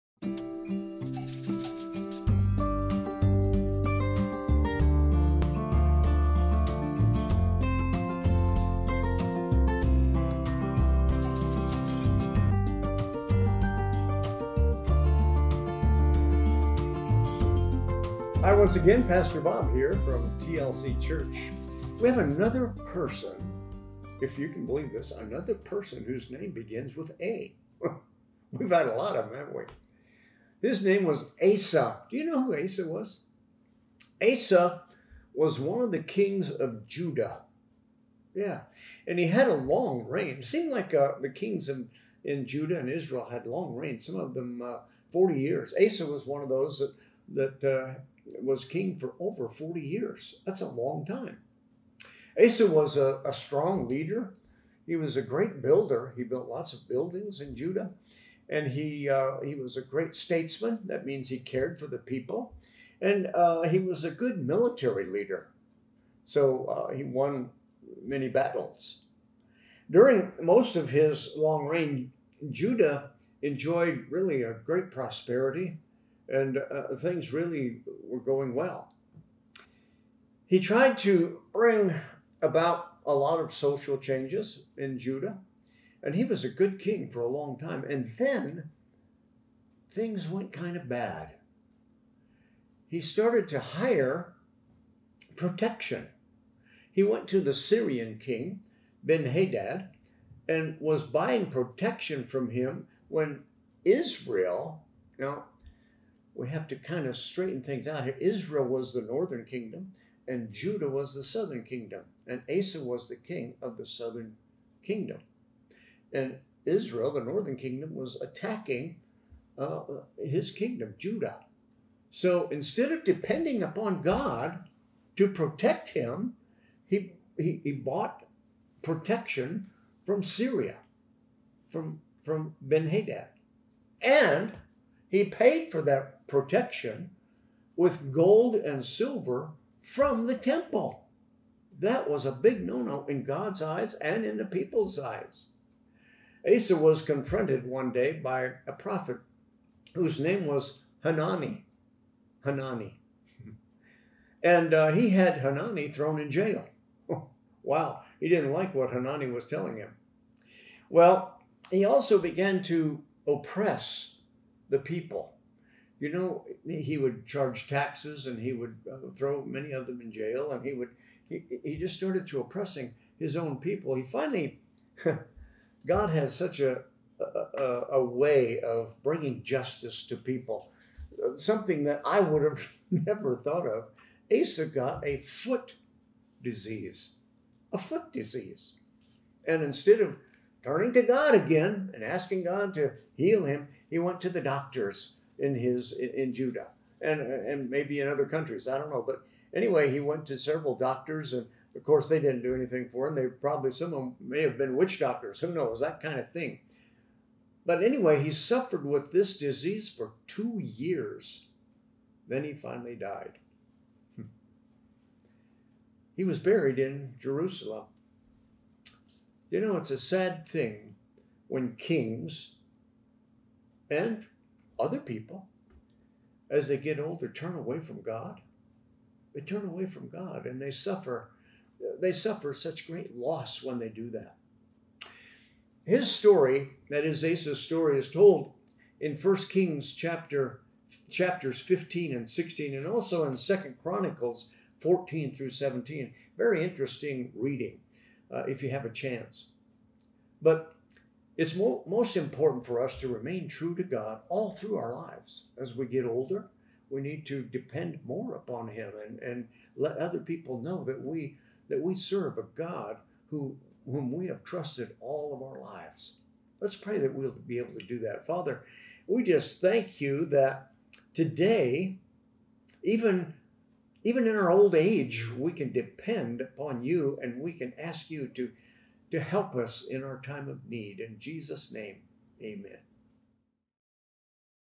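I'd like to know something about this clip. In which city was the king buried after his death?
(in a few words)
Jerusalem.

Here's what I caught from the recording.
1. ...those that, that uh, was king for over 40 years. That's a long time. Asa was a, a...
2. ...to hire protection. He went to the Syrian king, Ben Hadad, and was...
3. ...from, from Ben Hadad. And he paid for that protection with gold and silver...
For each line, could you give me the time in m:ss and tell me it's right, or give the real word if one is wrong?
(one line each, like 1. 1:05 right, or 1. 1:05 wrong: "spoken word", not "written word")
1. 0:46 right
2. 1:33 right
3. 2:11 right.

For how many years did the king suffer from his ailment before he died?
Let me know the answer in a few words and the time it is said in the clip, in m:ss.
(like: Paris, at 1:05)
2, at 3:30.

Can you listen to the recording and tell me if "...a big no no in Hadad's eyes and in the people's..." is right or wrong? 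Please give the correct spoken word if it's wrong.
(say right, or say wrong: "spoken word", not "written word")
wrong: "God", not "Hadad".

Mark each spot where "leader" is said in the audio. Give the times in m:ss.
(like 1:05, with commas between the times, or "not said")
0:53, 1:05.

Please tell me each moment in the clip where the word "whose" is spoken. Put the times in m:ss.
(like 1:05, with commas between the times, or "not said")
0:26, 2:29.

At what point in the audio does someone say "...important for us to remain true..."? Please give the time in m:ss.
4:12.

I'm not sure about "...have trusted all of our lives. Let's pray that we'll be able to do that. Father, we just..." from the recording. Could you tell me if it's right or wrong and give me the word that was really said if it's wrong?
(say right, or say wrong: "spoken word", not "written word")
right.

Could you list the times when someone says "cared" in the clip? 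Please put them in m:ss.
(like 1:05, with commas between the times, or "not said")
1:01.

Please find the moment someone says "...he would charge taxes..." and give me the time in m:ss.
2:46.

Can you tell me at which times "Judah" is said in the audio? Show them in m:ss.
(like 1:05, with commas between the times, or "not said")
0:36, 0:42, 0:57, 1:12, 1:24, 1:50, 2:00, 3:16.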